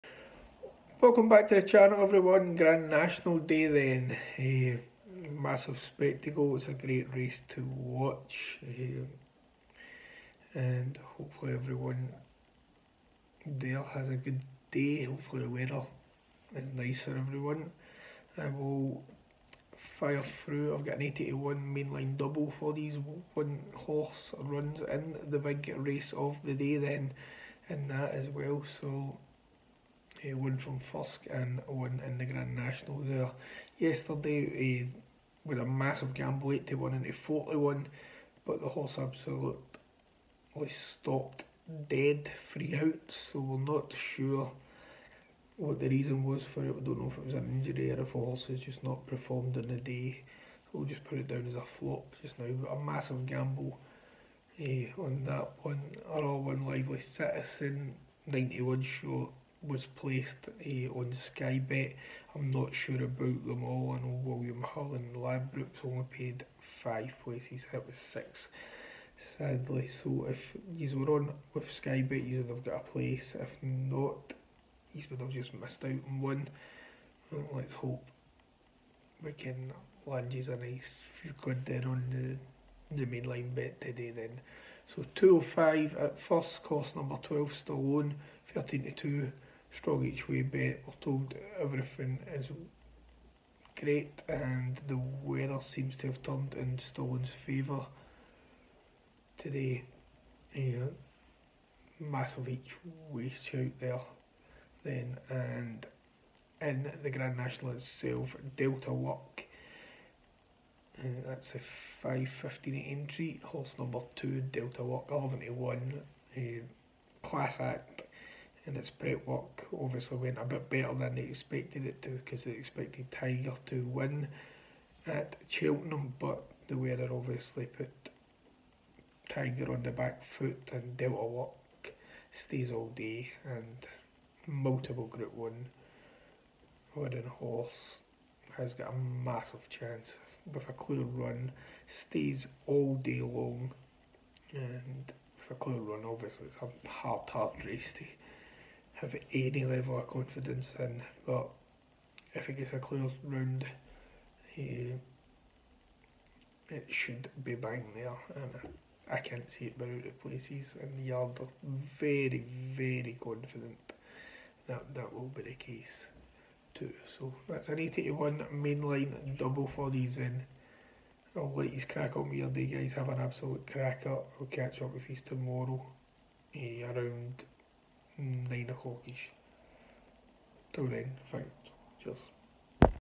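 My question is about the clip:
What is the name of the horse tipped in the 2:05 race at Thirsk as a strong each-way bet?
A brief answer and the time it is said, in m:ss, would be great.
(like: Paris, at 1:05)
Stallone, at 1:27.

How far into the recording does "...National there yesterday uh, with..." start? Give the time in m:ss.
0:32.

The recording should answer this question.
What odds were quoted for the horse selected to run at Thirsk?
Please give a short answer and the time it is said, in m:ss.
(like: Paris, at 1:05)
13/2, at 1:28.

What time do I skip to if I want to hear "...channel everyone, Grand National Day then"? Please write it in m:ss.
0:01.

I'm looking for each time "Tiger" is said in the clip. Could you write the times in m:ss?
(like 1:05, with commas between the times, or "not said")
2:03, 2:09.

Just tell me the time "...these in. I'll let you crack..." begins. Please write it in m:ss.
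2:49.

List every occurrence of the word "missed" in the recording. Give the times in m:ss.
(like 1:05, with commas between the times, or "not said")
1:15.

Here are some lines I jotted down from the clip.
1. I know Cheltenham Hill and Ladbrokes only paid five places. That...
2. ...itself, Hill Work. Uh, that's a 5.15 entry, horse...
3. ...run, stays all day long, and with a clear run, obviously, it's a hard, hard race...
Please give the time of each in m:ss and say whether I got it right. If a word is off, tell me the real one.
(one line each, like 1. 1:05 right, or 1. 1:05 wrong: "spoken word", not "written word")
1. 1:03 wrong: "William", not "Cheltenham"
2. 1:47 wrong: "Delta", not "Hill"
3. 2:21 right.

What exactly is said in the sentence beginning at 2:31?
But if it gets a clear round, he, it should be bang there.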